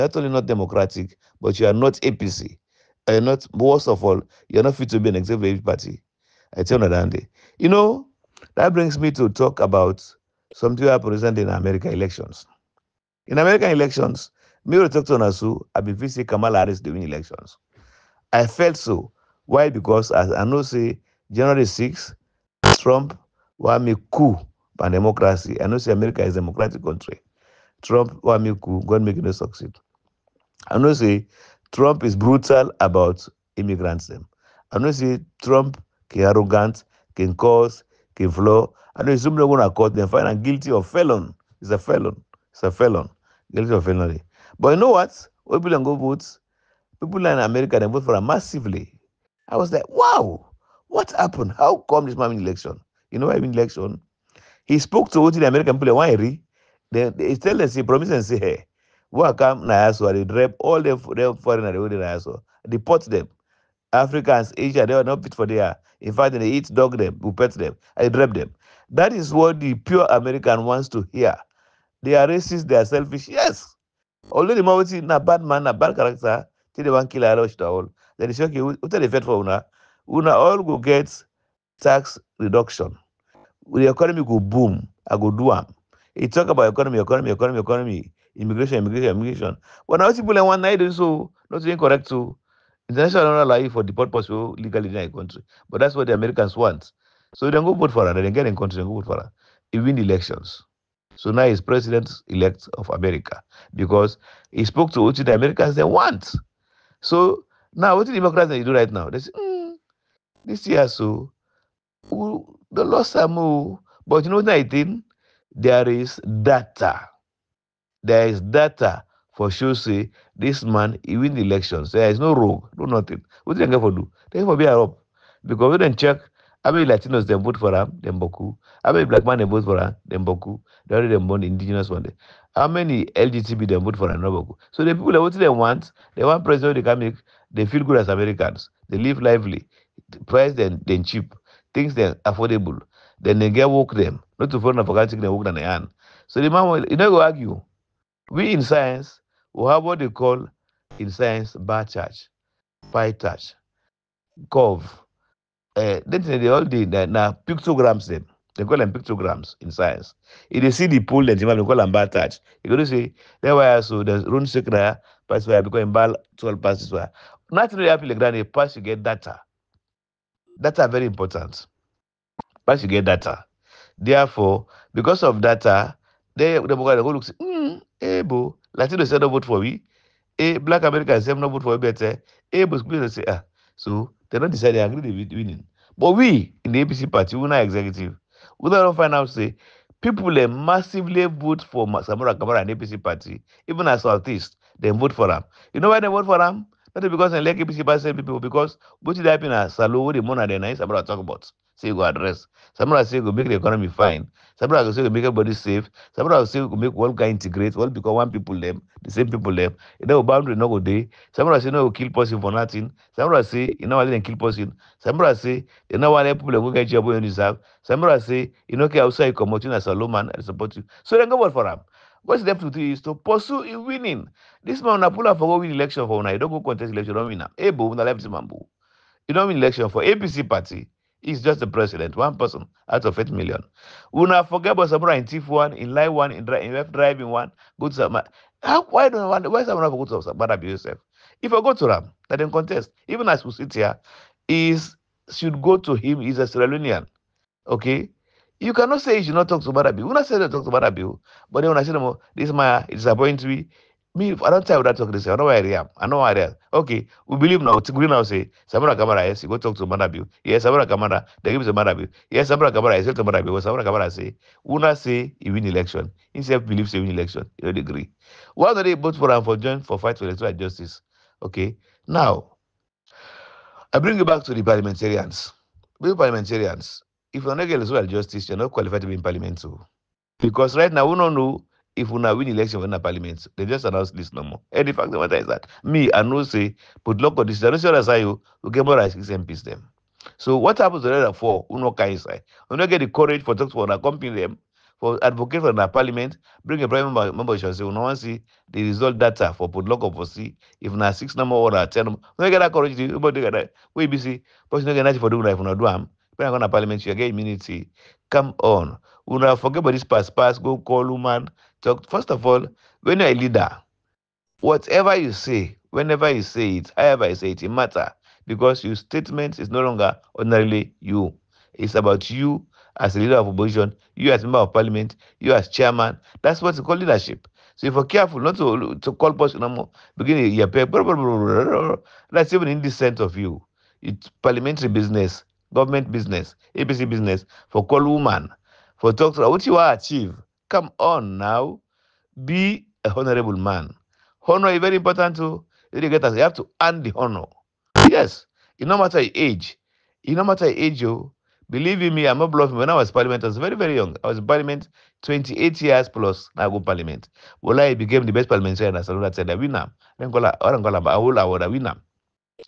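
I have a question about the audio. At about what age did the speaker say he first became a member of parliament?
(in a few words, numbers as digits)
28.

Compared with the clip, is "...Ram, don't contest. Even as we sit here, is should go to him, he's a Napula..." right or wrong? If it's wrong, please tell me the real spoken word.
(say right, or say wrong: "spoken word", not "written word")
wrong: "Sierra", not "Napula".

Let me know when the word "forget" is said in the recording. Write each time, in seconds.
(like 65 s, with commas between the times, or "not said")
234 s, 309 s.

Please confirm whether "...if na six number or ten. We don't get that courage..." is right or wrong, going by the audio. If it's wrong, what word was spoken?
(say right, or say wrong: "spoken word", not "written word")
right.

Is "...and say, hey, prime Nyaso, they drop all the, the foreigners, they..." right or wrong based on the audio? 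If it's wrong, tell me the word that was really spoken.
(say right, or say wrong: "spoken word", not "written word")
wrong: "welcome", not "prime".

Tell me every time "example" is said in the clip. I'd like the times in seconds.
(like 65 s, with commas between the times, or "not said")
not said.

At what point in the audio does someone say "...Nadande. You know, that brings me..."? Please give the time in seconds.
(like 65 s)
6 s.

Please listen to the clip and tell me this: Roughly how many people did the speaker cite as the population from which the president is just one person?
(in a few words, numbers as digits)
8 million.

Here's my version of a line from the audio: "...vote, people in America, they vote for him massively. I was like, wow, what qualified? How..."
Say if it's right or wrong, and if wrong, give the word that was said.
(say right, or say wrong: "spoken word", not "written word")
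wrong: "happened", not "qualified".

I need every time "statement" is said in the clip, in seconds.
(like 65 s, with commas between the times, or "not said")
318 s.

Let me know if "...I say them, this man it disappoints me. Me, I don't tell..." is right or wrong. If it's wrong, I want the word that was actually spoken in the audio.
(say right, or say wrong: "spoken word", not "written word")
right.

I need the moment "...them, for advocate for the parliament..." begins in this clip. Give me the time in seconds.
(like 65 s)
294 s.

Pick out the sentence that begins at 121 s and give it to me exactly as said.
There is no rogue, no nothing.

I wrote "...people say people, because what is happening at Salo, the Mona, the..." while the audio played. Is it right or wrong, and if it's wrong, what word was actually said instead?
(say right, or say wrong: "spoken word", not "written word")
right.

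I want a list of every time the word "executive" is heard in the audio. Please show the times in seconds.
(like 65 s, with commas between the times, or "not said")
5 s, 187 s.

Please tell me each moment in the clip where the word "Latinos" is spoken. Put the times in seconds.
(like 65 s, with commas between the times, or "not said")
126 s, 178 s.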